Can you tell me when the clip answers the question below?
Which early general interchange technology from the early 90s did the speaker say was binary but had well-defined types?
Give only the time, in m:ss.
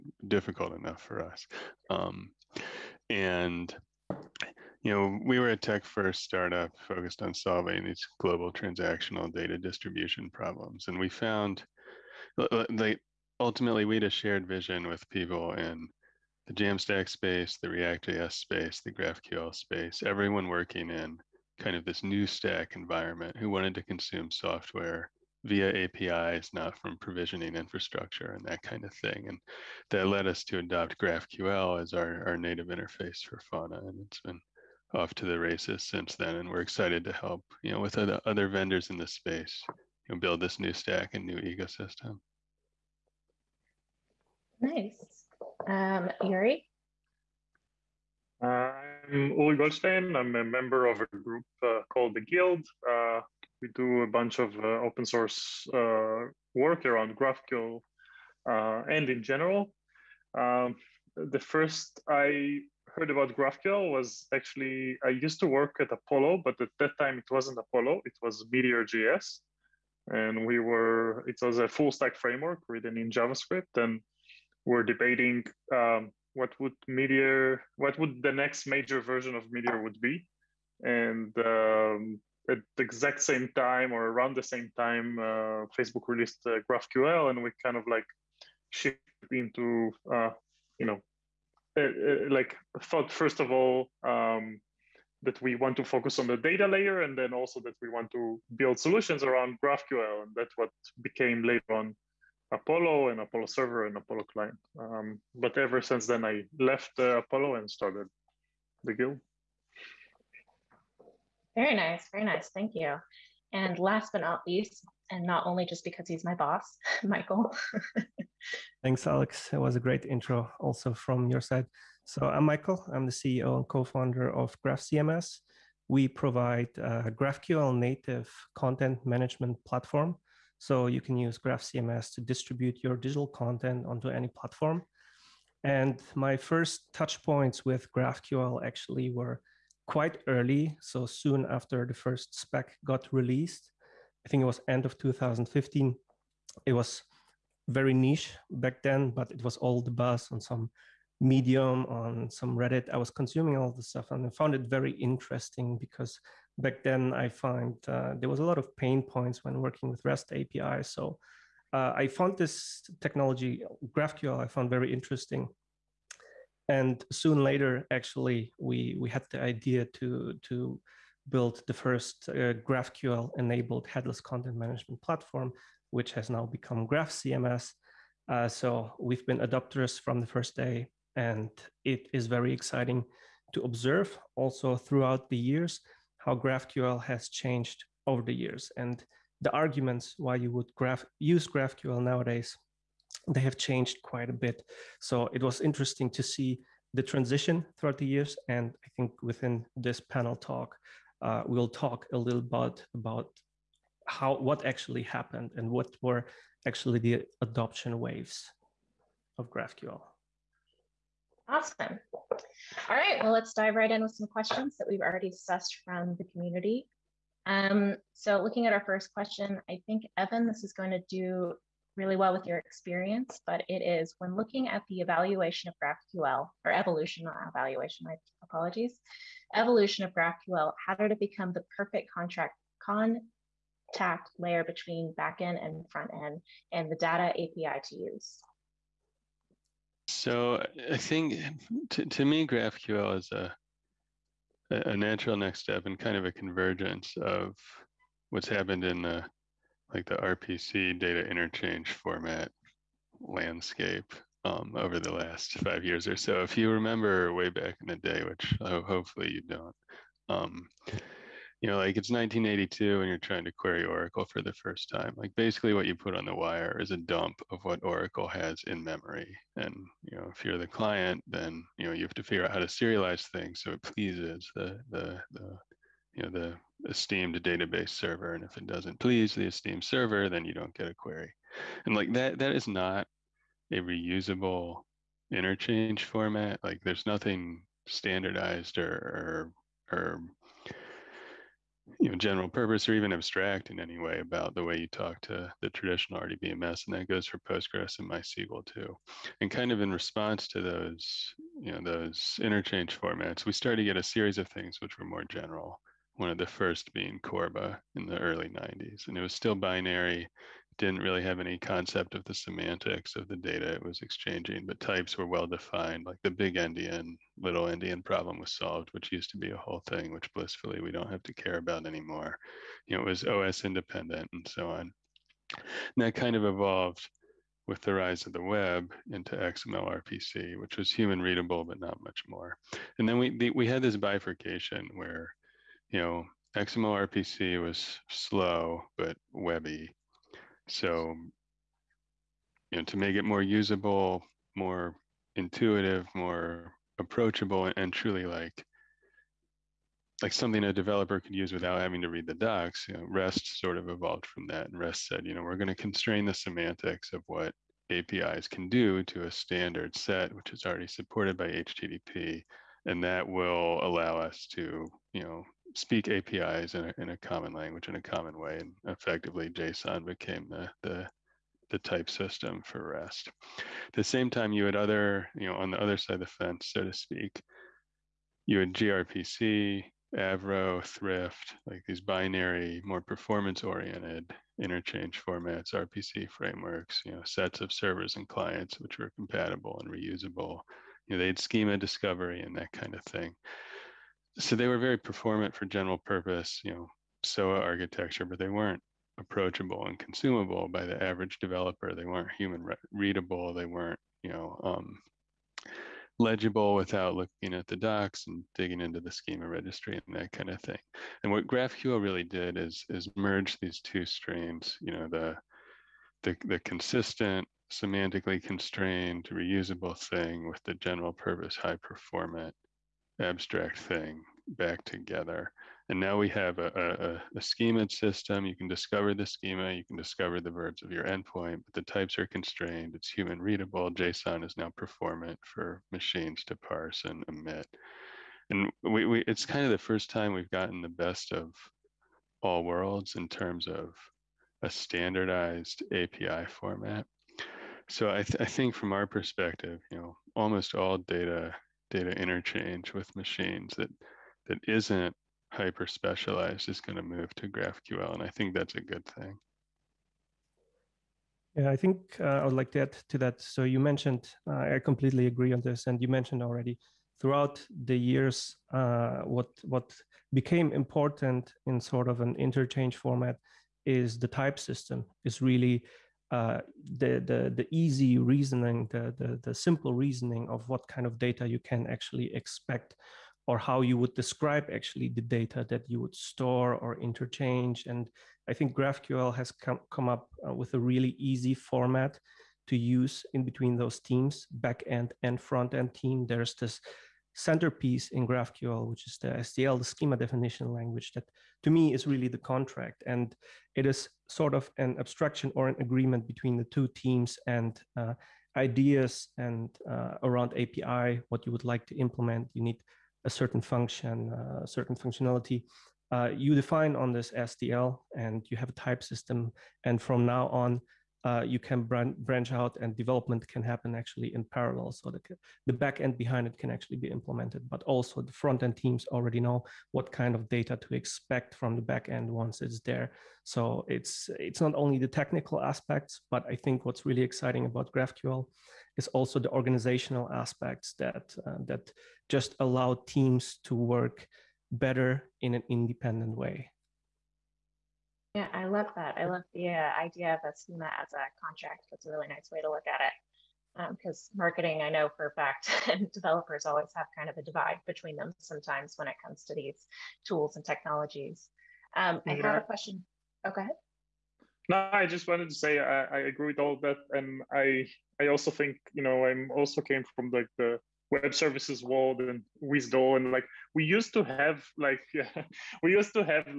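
5:07.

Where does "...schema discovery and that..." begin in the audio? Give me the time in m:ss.
6:31.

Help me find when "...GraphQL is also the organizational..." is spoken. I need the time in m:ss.
8:57.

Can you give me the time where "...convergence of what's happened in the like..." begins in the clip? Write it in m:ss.
4:06.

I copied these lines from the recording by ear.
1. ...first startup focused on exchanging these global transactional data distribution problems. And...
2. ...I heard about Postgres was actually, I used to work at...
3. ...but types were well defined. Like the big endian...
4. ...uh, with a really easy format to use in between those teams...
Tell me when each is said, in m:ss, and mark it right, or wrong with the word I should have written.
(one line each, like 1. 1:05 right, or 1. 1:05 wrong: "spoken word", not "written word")
1. 0:05 wrong: "solving", not "exchanging"
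2. 1:02 wrong: "GraphQL", not "Postgres"
3. 5:14 right
4. 8:10 right.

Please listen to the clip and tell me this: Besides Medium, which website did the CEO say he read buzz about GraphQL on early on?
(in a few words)
Reddit.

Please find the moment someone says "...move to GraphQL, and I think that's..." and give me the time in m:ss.
7:37.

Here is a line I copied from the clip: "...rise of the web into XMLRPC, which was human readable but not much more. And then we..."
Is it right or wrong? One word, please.
right.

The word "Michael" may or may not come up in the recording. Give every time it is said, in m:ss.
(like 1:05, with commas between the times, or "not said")
1:57, 2:02.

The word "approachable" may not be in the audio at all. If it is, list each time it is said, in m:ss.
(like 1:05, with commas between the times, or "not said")
5:46, 6:39.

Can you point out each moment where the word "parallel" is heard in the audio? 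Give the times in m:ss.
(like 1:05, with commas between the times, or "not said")
8:44.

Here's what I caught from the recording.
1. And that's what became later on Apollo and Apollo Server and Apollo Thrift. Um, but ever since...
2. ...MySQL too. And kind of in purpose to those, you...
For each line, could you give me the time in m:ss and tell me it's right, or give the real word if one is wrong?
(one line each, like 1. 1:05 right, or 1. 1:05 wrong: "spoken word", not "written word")
1. 1:40 wrong: "Client", not "Thrift"
2. 4:58 wrong: "response", not "purpose".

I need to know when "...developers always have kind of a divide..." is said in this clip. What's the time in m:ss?
9:16.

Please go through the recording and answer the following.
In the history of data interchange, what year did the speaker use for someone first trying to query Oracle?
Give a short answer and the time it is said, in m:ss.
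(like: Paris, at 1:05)
1982, at 4:22.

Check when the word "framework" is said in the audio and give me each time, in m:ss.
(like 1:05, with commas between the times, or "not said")
1:12, 6:26.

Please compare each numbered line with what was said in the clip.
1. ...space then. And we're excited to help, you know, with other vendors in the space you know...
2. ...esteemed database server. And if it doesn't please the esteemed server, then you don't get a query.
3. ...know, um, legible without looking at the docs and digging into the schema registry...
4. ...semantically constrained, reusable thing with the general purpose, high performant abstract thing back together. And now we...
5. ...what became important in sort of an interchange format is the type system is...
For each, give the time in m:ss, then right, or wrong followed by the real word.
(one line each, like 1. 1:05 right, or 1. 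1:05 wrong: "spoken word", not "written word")
1. 0:35 wrong: "since", not "space"
2. 4:36 right
3. 6:44 right
4. 6:57 right
5. 7:49 right.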